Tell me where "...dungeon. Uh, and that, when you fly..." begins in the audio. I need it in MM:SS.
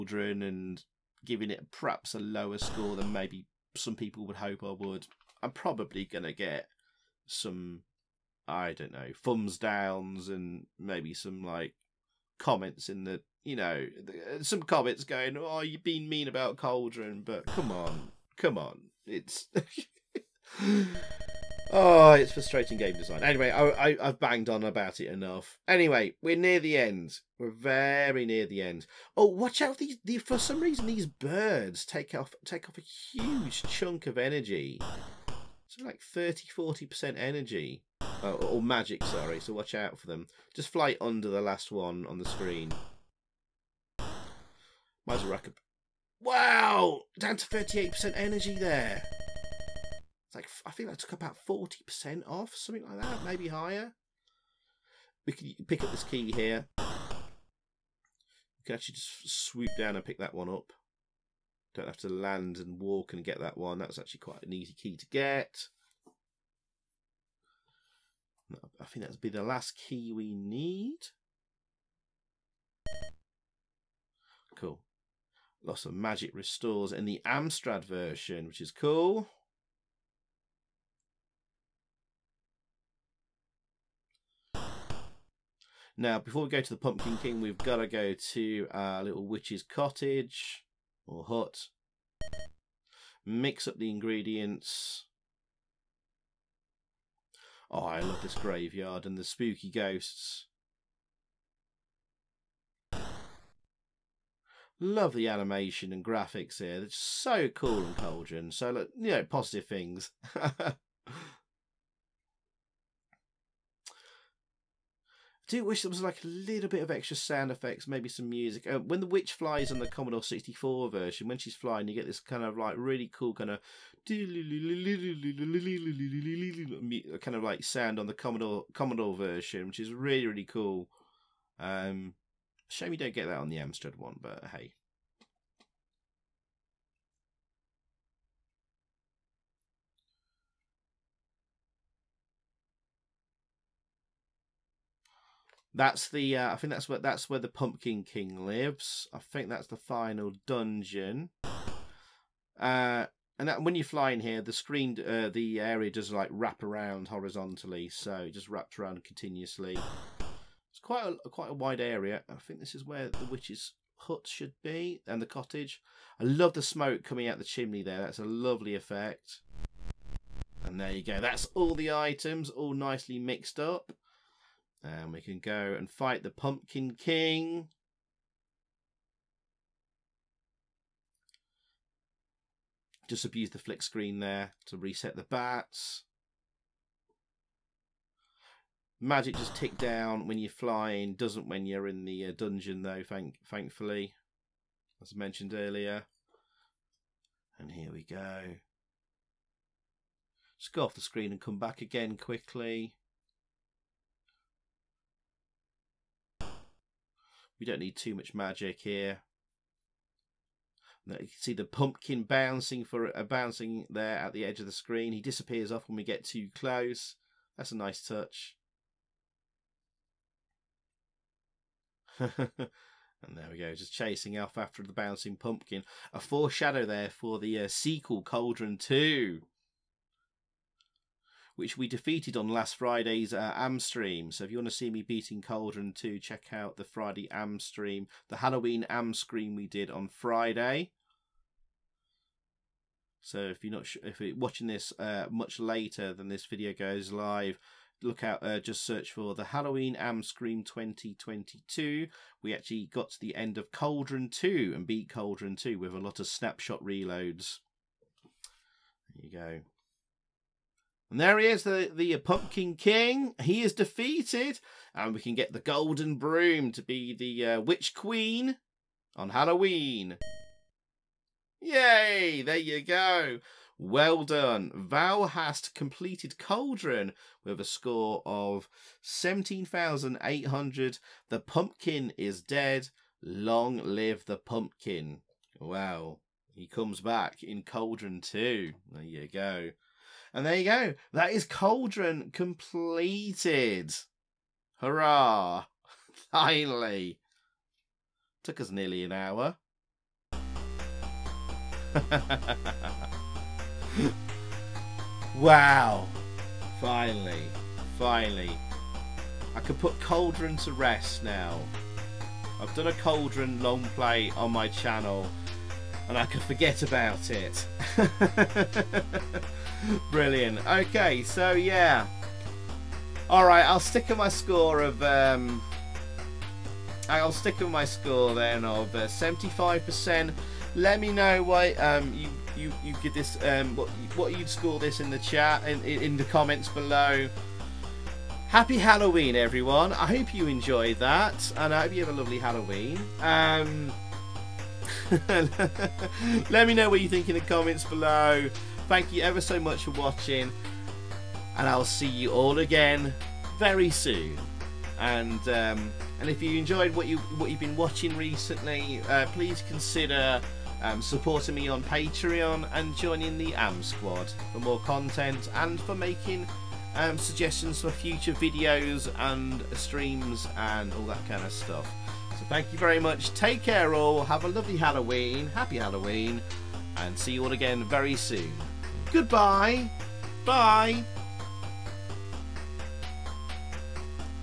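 02:30.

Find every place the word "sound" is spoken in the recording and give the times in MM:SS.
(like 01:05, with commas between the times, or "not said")
01:57, 02:07.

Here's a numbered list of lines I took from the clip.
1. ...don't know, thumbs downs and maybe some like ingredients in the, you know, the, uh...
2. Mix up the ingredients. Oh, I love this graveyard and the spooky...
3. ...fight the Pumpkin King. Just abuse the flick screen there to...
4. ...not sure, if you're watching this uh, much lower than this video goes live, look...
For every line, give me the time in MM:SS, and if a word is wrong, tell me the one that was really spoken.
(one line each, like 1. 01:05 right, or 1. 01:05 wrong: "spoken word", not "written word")
1. 00:08 wrong: "comments", not "ingredients"
2. 01:33 right
3. 02:55 right
4. 04:03 wrong: "later", not "lower".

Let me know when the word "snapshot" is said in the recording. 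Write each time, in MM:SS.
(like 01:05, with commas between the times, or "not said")
04:16.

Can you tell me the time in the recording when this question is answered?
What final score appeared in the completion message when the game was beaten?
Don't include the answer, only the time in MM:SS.
04:39.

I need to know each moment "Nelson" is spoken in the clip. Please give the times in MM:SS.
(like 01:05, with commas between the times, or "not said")
not said.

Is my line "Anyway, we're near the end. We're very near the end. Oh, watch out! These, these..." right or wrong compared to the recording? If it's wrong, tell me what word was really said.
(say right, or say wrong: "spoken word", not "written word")
right.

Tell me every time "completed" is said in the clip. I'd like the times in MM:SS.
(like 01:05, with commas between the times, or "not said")
04:35, 04:52.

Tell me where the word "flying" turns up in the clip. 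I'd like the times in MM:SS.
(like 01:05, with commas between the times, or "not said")
02:01, 03:10.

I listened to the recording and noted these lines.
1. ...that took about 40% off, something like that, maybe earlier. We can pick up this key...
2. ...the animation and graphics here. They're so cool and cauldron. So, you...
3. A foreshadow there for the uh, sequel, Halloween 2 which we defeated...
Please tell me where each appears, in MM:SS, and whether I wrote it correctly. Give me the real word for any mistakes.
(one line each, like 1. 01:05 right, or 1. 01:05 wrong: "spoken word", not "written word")
1. 00:50 wrong: "higher", not "earlier"
2. 01:45 right
3. 03:46 wrong: "Cauldron", not "Halloween".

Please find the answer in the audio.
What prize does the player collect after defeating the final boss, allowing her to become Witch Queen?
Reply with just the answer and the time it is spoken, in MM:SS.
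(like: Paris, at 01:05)
Golden Broom, at 04:25.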